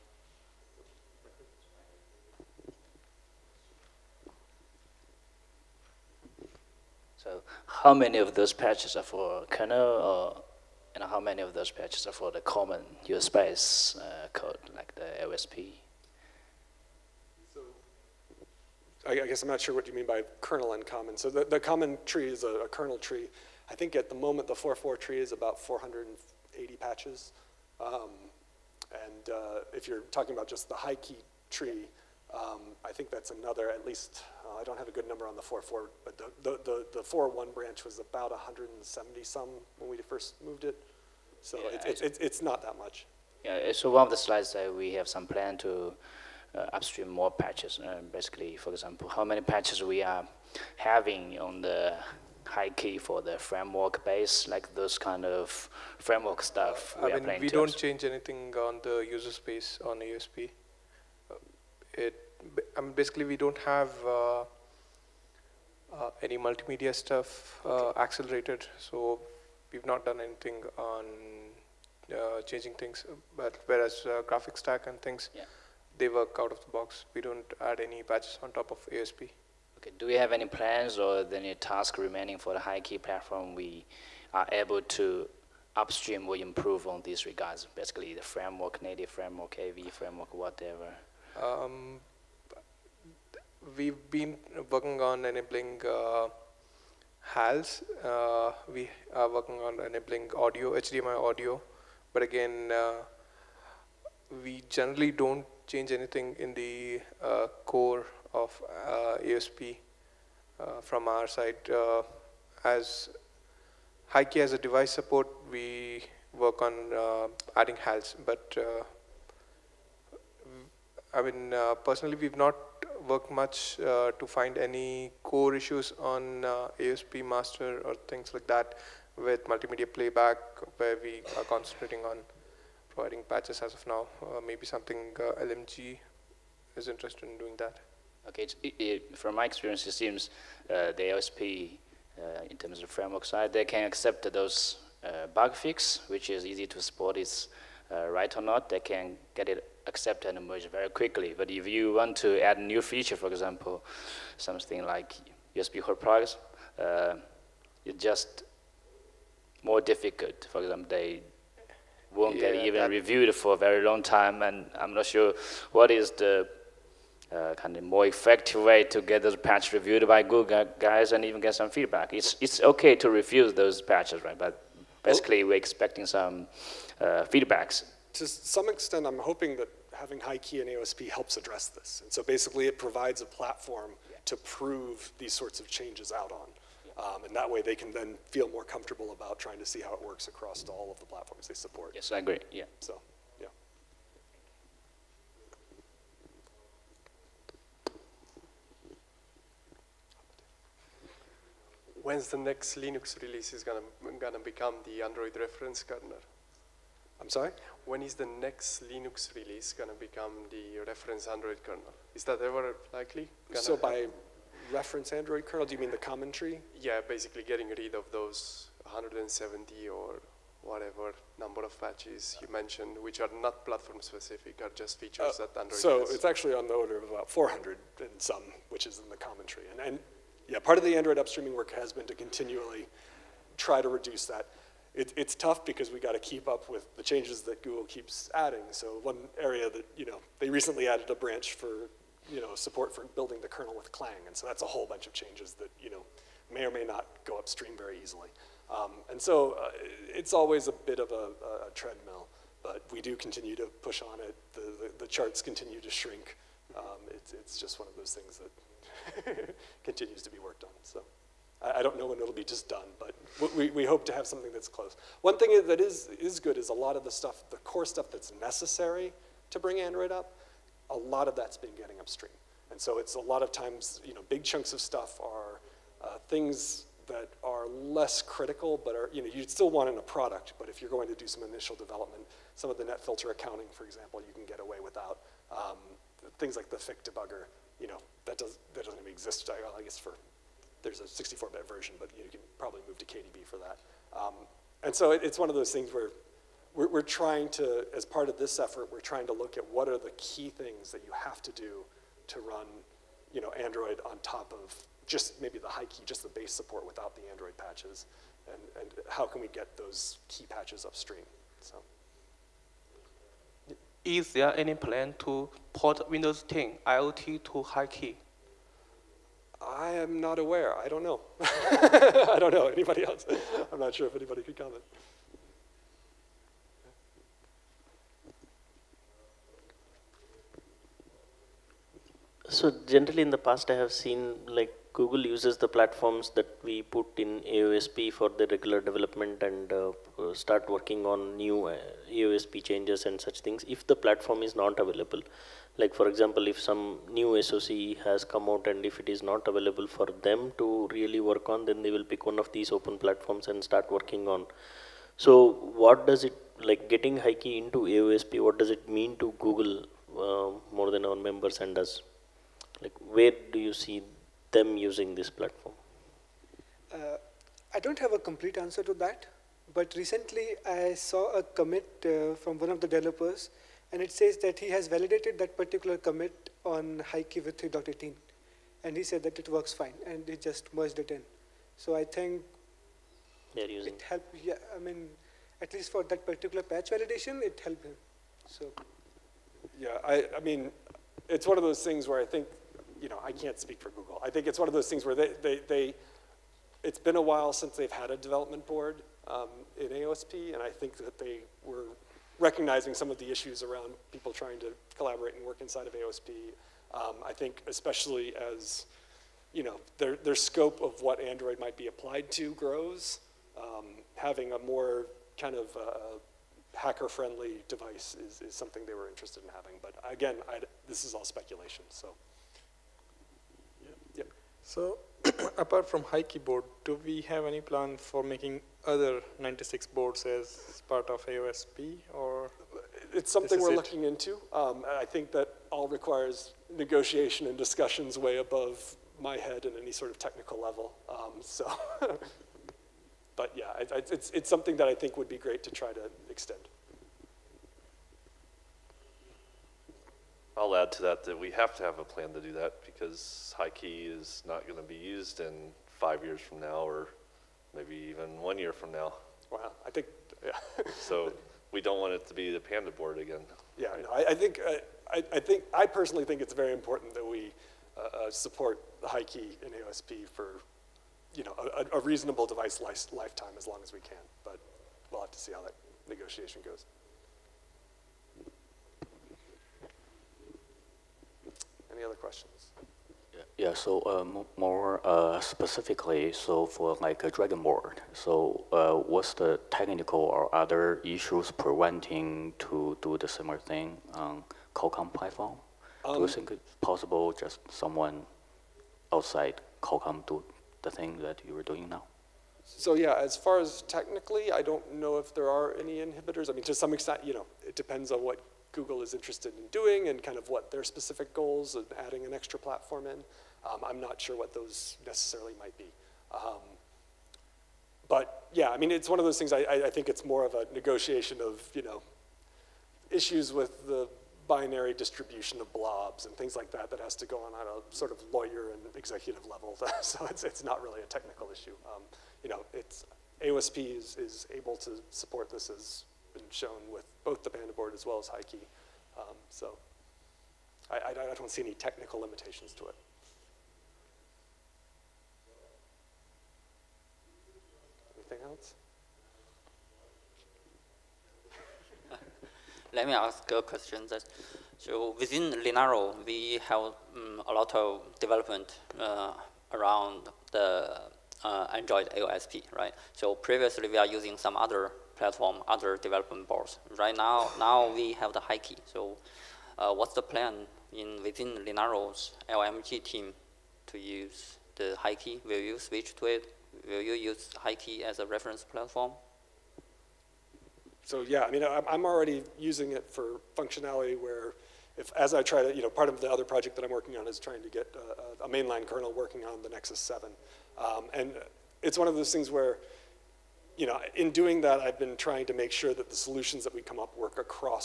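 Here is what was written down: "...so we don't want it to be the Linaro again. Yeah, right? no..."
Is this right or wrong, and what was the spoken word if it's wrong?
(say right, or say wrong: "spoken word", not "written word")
wrong: "PandaBoard", not "Linaro".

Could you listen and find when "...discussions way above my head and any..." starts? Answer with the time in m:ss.
7:17.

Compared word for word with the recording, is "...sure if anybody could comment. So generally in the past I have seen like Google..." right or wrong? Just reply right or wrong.
right.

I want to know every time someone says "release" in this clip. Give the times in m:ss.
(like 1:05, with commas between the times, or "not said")
3:23, 3:29.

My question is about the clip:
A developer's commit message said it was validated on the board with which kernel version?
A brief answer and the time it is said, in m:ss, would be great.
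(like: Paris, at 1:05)
3.18, at 6:17.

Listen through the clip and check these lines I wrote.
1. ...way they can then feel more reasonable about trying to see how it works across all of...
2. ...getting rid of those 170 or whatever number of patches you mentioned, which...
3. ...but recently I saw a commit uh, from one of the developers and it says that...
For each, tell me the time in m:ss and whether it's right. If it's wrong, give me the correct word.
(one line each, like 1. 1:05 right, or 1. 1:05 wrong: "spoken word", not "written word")
1. 3:07 wrong: "comfortable", not "reasonable"
2. 3:37 right
3. 6:09 right.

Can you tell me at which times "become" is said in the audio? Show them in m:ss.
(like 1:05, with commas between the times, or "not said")
3:24, 3:29.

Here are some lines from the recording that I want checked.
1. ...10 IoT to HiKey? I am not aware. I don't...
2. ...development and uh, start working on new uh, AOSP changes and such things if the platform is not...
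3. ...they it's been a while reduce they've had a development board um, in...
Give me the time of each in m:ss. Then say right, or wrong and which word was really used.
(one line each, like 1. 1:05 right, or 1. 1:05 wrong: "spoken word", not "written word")
1. 5:16 right
2. 5:38 right
3. 6:35 wrong: "since", not "reduce".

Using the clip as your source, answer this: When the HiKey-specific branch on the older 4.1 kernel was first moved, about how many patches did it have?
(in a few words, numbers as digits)
170.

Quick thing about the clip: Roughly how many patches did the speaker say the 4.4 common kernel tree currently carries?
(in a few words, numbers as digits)
480.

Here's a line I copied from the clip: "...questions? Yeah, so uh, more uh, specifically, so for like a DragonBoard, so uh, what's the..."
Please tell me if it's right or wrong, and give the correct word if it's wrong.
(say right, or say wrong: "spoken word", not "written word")
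right.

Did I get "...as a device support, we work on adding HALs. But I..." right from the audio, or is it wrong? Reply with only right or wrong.
right.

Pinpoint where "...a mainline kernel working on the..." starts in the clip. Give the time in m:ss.
9:48.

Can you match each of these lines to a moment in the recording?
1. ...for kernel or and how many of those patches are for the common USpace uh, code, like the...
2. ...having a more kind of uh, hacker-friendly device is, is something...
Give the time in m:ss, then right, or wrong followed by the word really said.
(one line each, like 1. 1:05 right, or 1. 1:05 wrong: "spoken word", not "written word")
1. 0:09 right
2. 6:54 right.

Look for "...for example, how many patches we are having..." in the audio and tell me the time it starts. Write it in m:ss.
0:48.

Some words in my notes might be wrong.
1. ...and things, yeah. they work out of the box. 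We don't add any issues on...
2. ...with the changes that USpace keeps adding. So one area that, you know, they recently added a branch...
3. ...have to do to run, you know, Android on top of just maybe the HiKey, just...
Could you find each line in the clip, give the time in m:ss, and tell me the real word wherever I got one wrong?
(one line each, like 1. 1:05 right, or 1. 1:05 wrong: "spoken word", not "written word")
1. 1:14 wrong: "patches", not "issues"
2. 3:56 wrong: "Google", not "USpace"
3. 5:01 right.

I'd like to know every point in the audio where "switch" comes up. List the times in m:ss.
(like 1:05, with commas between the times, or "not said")
9:35.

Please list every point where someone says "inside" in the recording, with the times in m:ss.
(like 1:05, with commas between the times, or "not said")
6:45.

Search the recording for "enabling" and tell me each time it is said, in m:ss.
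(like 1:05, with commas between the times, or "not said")
1:35, 1:39.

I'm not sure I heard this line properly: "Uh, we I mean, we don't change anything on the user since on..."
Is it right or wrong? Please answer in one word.
wrong.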